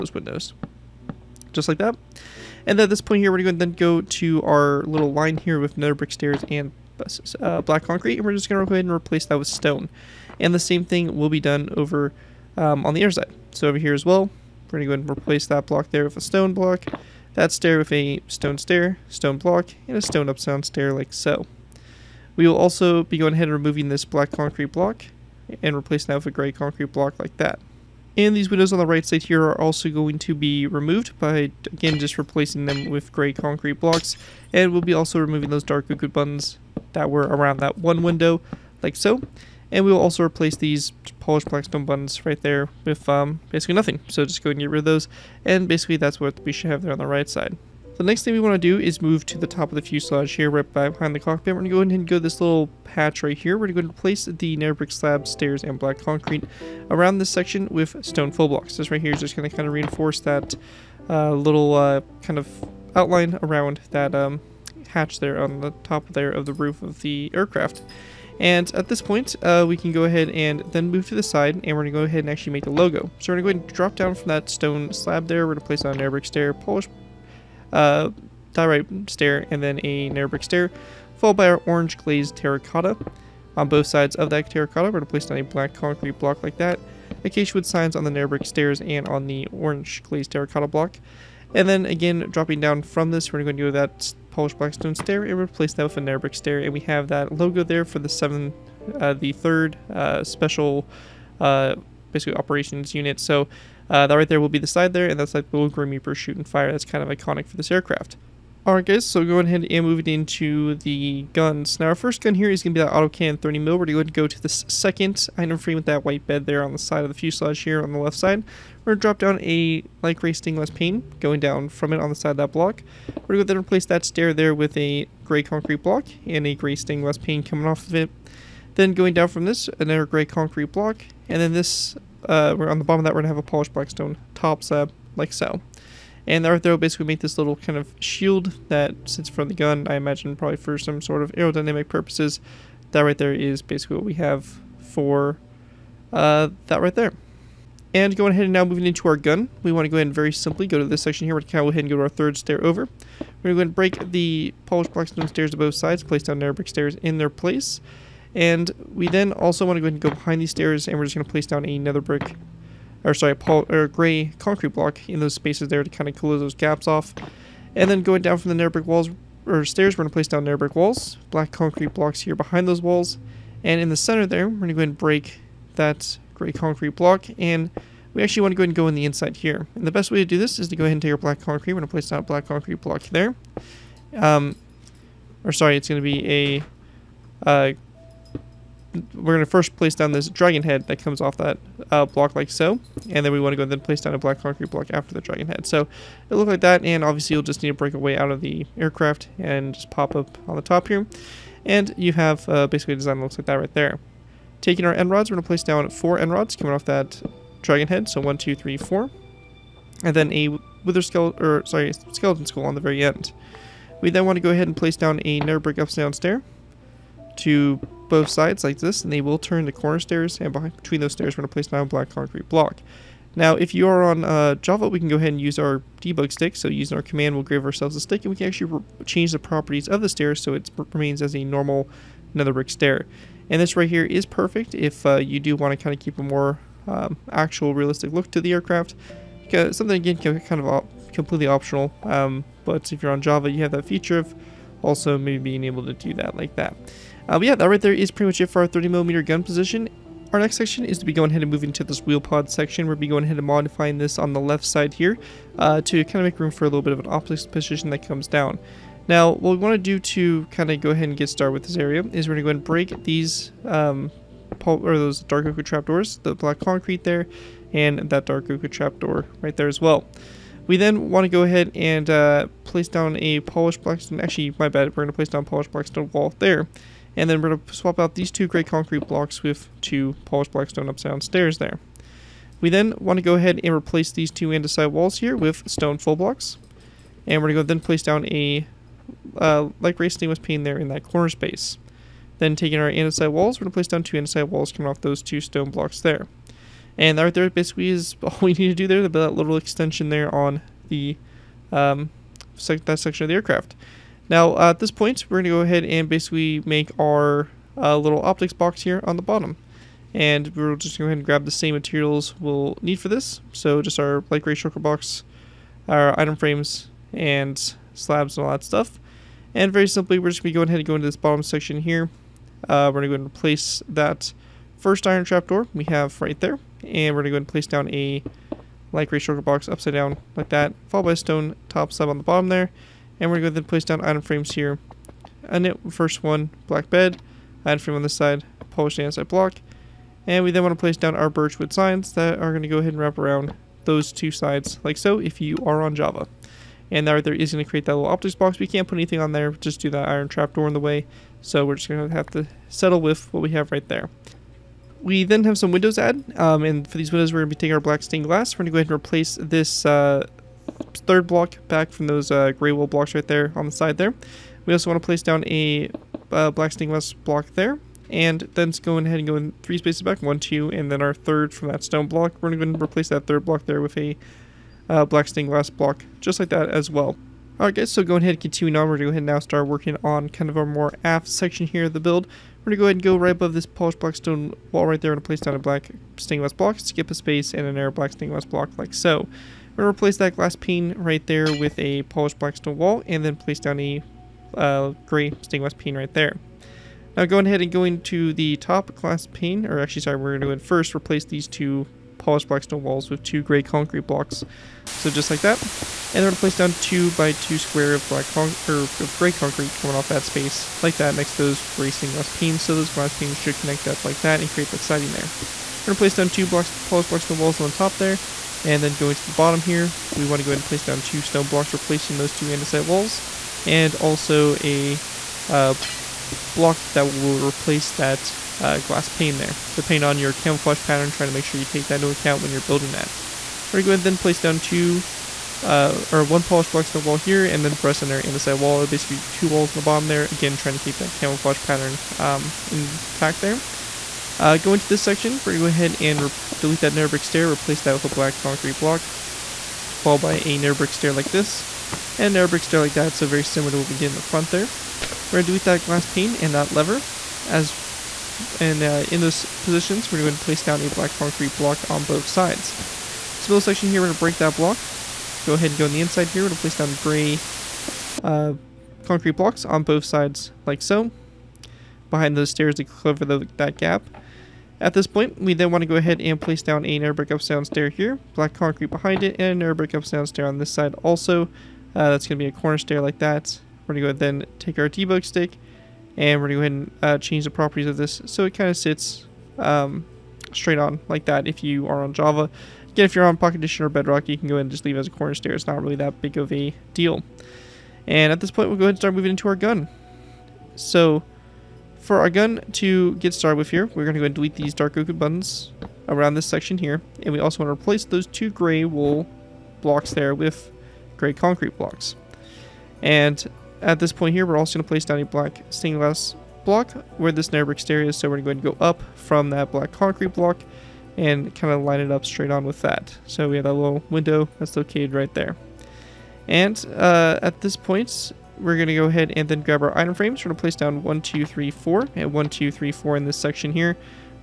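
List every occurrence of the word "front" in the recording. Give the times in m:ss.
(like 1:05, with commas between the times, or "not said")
2:19, 7:34.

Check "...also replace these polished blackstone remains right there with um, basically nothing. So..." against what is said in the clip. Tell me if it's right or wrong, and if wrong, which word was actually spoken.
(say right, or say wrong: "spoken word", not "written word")
wrong: "buttons", not "remains".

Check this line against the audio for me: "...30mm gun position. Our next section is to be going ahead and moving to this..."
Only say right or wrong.
right.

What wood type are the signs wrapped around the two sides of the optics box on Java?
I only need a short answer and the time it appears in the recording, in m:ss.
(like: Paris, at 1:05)
birchwood, at 5:41.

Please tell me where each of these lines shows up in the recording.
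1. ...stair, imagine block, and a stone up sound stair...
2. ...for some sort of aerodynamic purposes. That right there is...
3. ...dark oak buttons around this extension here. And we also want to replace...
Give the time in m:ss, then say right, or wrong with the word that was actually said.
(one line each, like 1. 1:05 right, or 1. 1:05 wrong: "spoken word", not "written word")
1. 0:18 wrong: "stone", not "imagine"
2. 2:20 right
3. 8:24 wrong: "section", not "extension".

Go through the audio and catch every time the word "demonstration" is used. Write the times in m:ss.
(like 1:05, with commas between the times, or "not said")
not said.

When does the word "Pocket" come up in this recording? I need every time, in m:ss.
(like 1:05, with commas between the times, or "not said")
8:13.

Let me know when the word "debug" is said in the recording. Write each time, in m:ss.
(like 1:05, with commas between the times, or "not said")
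3:46, 8:04.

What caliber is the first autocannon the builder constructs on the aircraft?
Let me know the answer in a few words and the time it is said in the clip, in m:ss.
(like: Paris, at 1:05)
30 mil, at 1:53.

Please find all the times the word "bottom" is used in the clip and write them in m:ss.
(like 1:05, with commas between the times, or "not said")
2:12, 5:09, 5:21, 5:32, 6:59, 7:19.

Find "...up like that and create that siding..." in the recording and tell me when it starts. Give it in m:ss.
6:53.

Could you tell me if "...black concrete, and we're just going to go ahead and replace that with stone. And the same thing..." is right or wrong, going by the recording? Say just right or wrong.
right.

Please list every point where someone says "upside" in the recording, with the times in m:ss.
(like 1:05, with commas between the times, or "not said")
3:35, 5:29.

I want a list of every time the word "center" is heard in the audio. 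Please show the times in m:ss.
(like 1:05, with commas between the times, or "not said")
2:53.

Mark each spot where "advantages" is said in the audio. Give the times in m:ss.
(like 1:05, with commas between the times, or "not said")
not said.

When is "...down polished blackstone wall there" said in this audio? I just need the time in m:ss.
4:35.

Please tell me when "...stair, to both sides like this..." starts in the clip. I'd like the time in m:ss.
3:36.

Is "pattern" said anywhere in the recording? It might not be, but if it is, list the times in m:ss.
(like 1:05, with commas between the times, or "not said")
7:10, 7:21.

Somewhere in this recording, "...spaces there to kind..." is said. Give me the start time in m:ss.
2:45.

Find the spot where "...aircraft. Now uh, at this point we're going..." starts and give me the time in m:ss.
5:03.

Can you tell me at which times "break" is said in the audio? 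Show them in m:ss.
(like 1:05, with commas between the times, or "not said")
2:33, 2:54, 3:17, 4:22, 7:44.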